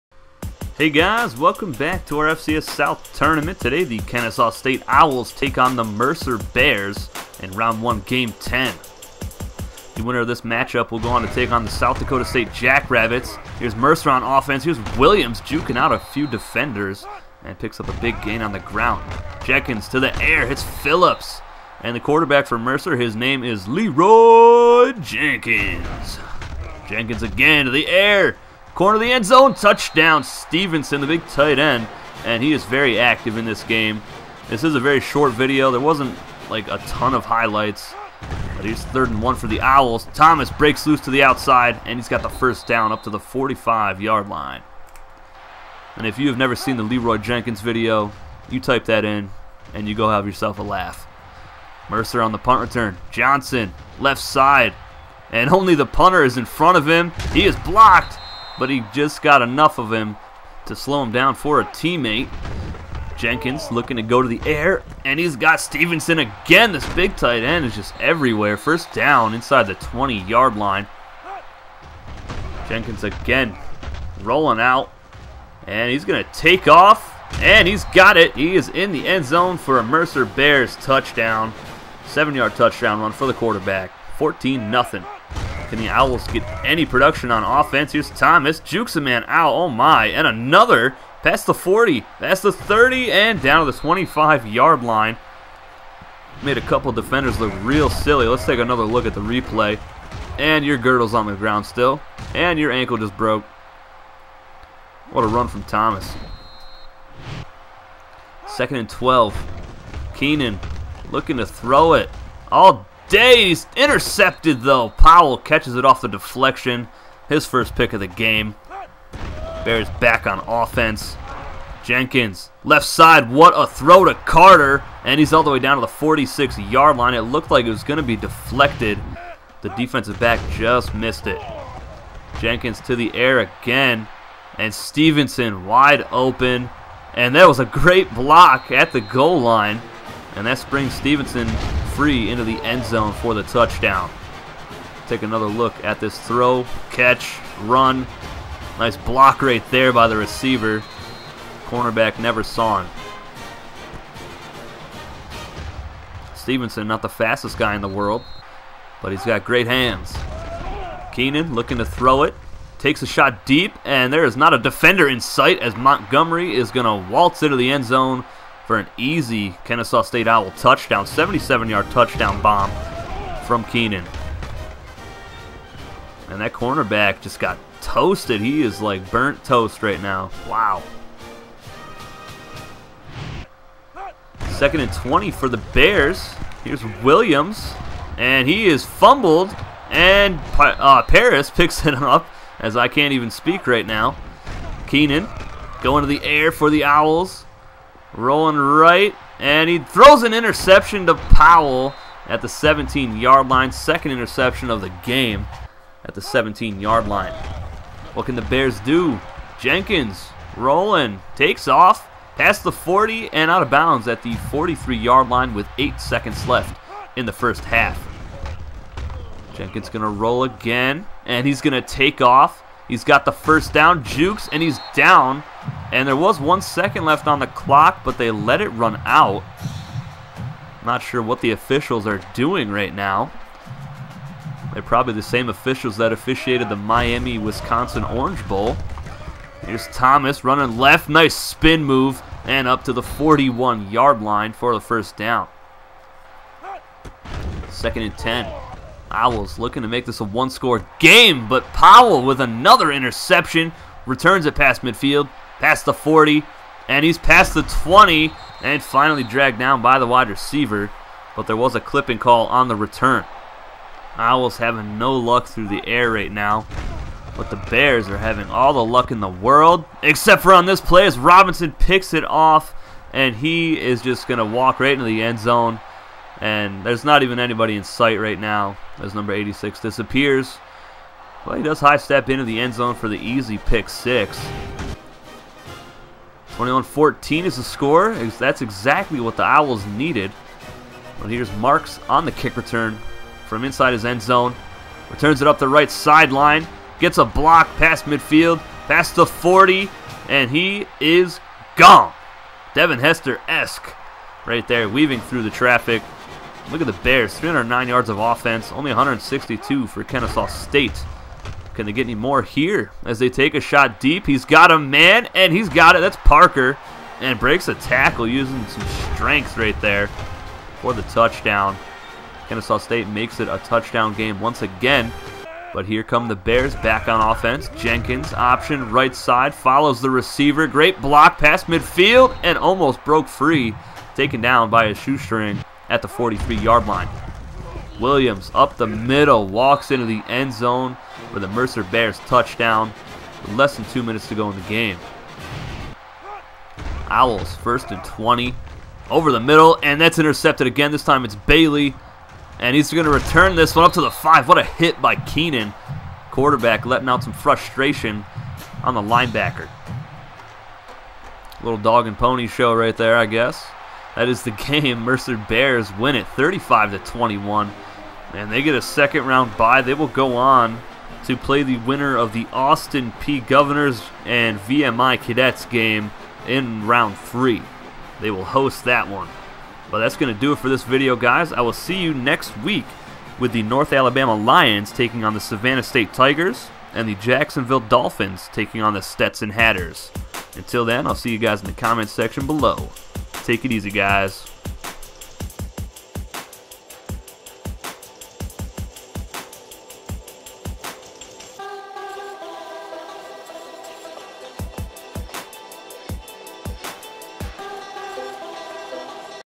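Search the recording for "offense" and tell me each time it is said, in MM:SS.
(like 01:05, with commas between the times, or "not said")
00:14, 01:27, 02:00, 05:08, 05:27.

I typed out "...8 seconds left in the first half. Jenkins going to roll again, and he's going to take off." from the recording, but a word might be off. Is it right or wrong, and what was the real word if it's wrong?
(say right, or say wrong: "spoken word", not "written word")
right.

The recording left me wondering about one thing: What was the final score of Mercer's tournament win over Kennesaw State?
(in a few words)
35-21.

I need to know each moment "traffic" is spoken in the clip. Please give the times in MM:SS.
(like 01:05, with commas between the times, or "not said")
05:05.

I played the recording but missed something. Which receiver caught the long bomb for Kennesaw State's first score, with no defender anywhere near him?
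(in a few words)
Montgomery.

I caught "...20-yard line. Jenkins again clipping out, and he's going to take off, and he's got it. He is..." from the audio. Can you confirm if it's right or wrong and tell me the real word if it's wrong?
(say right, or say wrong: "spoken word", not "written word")
wrong: "rolling", not "clipping".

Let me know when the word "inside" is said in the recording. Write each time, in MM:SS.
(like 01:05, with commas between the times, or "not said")
01:09, 04:53.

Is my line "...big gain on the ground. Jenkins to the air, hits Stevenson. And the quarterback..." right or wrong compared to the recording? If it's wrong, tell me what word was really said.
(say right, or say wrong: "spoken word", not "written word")
wrong: "Phillips", not "Stevenson".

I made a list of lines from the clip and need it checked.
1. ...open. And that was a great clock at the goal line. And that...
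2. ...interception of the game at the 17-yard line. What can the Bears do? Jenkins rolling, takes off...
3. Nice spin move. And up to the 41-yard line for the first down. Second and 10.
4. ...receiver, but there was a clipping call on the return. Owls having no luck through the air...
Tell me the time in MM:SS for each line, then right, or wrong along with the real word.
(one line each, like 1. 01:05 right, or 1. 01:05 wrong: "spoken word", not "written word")
1. 02:16 wrong: "block", not "clock"
2. 03:24 right
3. 04:01 right
4. 04:20 right.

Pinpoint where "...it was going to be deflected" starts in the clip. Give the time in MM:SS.
02:07.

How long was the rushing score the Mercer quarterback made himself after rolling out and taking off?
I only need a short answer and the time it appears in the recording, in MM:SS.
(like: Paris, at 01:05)
7 yards, at 01:22.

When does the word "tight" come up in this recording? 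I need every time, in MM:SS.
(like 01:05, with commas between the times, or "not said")
00:31, 01:07.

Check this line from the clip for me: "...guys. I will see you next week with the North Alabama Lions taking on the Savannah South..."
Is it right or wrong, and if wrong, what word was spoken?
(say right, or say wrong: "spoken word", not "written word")
wrong: "State", not "South".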